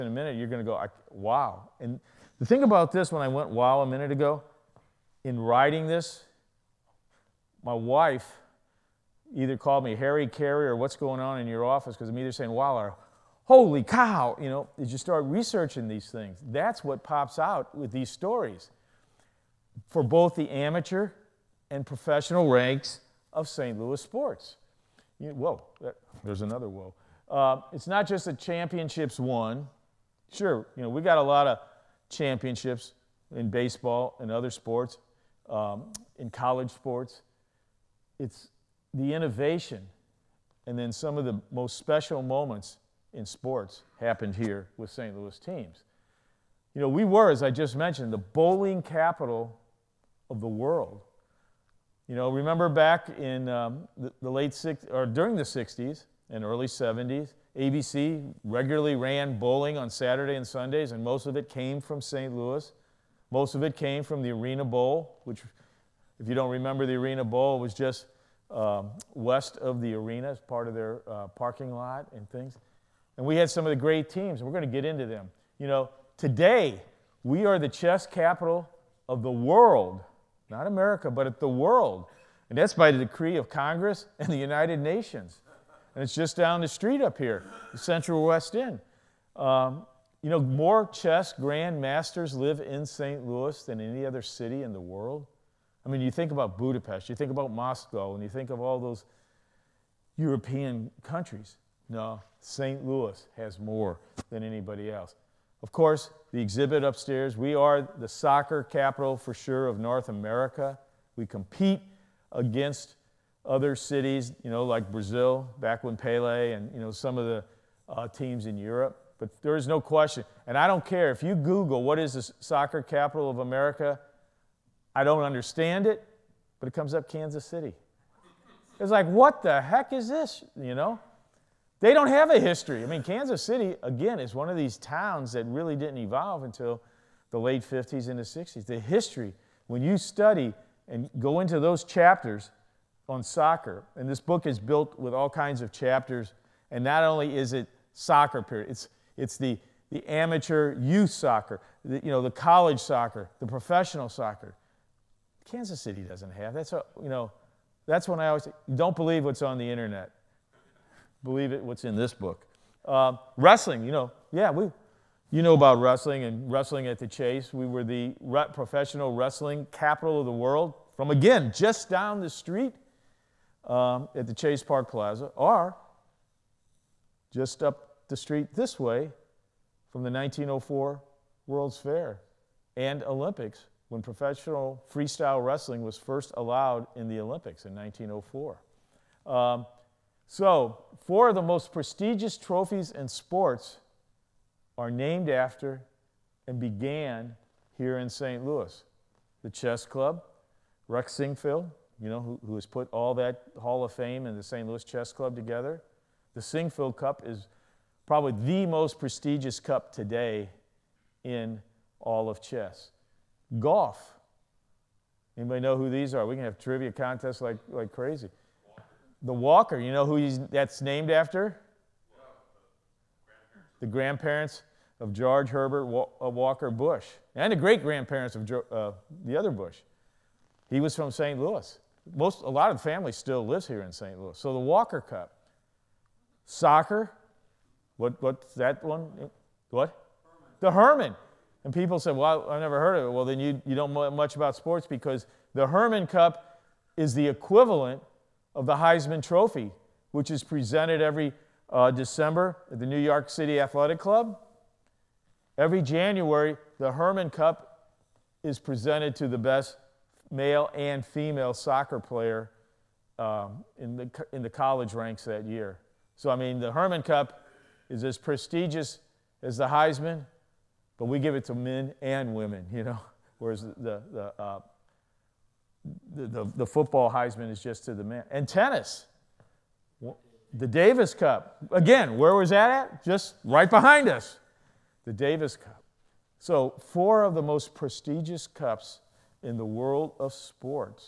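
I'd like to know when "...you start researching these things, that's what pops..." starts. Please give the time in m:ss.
0:14.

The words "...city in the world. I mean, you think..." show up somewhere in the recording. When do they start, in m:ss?
1:34.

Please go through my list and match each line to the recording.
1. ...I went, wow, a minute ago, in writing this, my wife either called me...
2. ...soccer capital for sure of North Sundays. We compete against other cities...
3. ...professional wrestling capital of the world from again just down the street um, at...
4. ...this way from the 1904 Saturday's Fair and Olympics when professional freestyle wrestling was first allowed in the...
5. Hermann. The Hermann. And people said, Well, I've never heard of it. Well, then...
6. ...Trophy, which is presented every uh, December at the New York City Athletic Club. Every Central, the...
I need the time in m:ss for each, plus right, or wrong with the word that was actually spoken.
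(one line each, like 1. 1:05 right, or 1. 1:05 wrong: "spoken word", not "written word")
1. 0:03 right
2. 1:48 wrong: "America", not "Sundays"
3. 2:48 right
4. 2:58 wrong: "World", not "Saturday"
5. 4:00 right
6. 4:09 wrong: "January", not "Central".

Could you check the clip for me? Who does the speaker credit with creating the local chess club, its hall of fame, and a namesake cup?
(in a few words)
Rex Sinquefield.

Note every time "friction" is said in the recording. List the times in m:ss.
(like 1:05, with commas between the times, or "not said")
not said.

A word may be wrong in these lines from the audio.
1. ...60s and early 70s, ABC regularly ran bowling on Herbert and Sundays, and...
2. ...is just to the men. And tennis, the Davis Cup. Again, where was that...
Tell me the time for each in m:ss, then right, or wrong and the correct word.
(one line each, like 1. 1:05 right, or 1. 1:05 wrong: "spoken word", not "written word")
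1. 0:55 wrong: "Saturday", not "Herbert"
2. 4:37 right.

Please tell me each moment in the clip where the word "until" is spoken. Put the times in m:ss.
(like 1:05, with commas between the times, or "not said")
2:16.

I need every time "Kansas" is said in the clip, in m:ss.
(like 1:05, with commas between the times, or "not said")
2:07, 2:13, 2:35.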